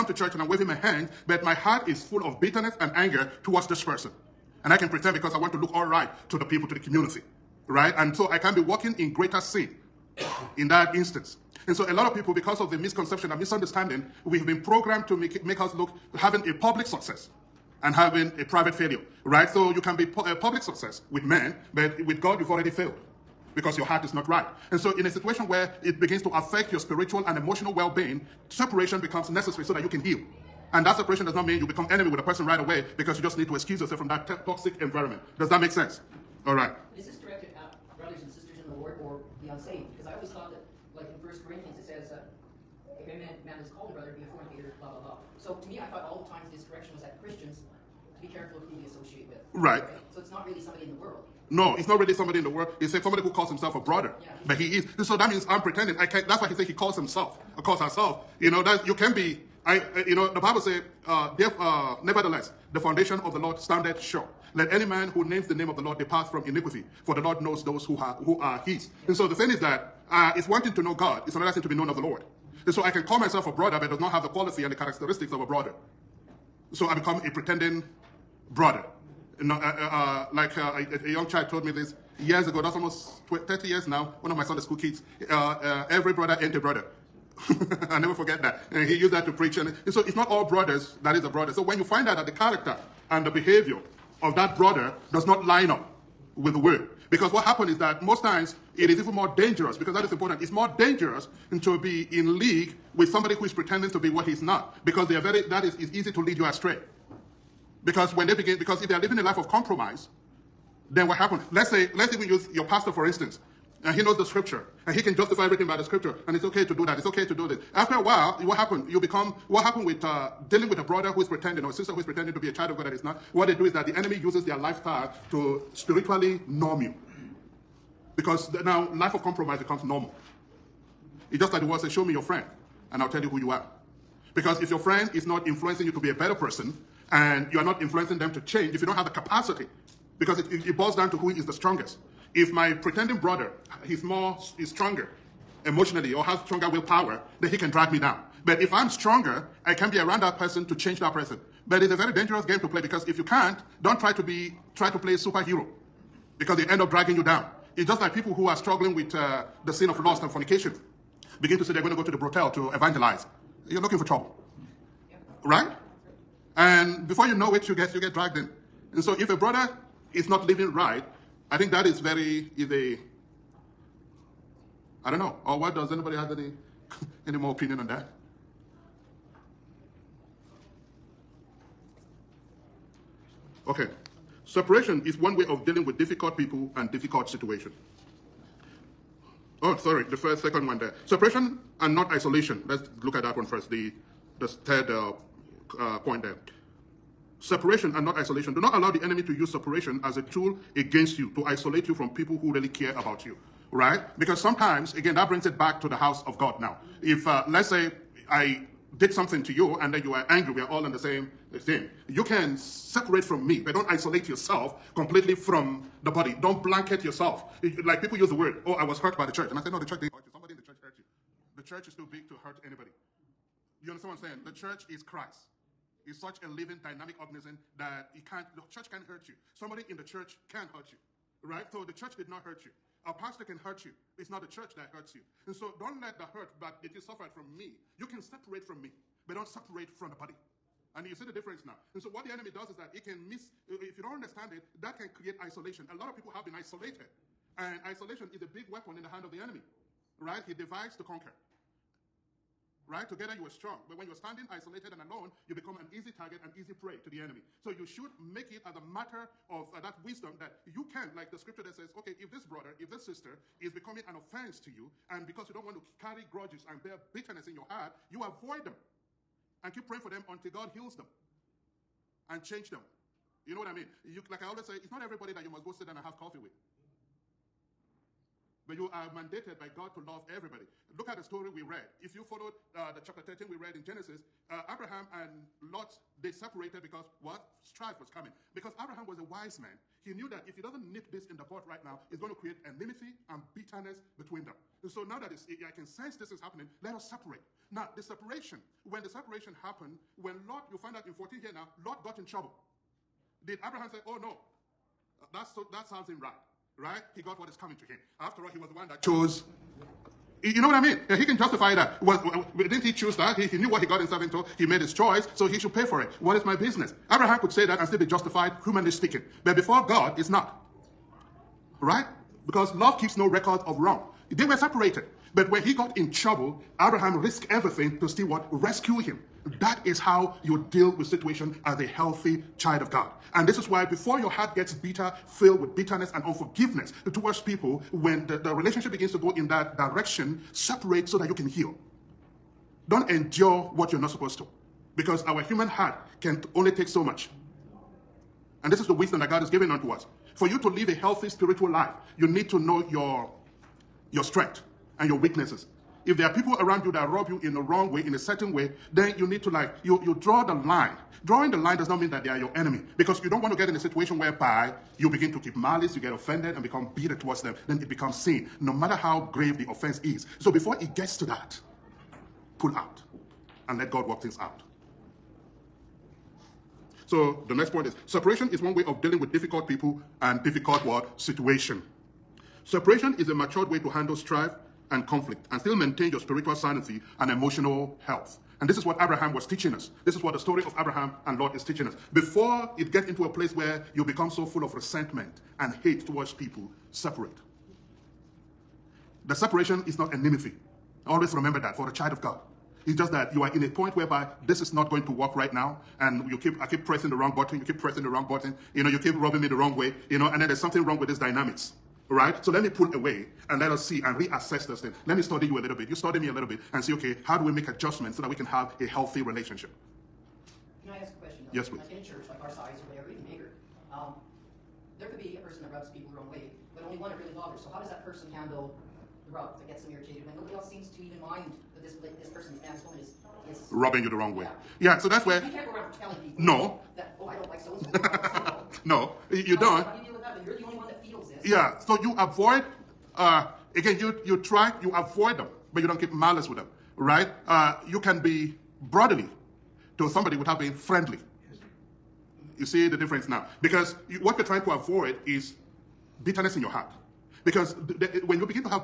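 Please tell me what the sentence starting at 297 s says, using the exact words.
Now, the separation, when the separation happened, when Lot, you find out in 14 here now, Lot got in trouble.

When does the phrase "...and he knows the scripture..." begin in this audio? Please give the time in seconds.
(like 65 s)
113 s.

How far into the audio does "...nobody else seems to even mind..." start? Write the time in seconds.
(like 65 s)
430 s.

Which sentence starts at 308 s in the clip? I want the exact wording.
After all, he was the one that chose.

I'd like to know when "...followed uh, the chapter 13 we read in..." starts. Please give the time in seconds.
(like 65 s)
282 s.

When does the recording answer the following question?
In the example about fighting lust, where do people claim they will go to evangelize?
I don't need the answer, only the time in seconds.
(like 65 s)
162 s.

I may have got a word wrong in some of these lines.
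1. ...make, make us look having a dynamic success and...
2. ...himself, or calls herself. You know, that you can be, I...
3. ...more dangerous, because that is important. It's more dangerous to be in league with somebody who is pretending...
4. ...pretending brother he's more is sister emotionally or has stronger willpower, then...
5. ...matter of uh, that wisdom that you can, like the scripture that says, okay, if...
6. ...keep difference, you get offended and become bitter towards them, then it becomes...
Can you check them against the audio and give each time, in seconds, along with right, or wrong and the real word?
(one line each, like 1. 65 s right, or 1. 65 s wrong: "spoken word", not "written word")
1. 15 s wrong: "public", not "dynamic"
2. 56 s right
3. 99 s right
4. 142 s wrong: "stronger", not "sister"
5. 258 s right
6. 365 s wrong: "malice", not "difference".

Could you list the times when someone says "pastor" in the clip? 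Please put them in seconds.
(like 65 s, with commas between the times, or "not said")
112 s, 233 s.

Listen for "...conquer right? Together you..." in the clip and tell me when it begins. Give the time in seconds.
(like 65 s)
251 s.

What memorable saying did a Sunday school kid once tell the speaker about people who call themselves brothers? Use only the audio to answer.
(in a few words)
every brother ain't a brother.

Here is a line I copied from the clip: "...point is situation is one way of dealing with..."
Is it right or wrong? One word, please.
wrong.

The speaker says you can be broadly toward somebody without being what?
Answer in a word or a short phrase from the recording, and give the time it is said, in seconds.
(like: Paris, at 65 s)
friendly, at 450 s.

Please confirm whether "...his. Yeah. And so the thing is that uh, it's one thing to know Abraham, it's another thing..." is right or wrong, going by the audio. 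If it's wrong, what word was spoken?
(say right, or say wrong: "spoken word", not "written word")
wrong: "God", not "Abraham".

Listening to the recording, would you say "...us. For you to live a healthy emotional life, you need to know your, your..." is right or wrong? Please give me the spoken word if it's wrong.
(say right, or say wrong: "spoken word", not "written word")
wrong: "spiritual", not "emotional".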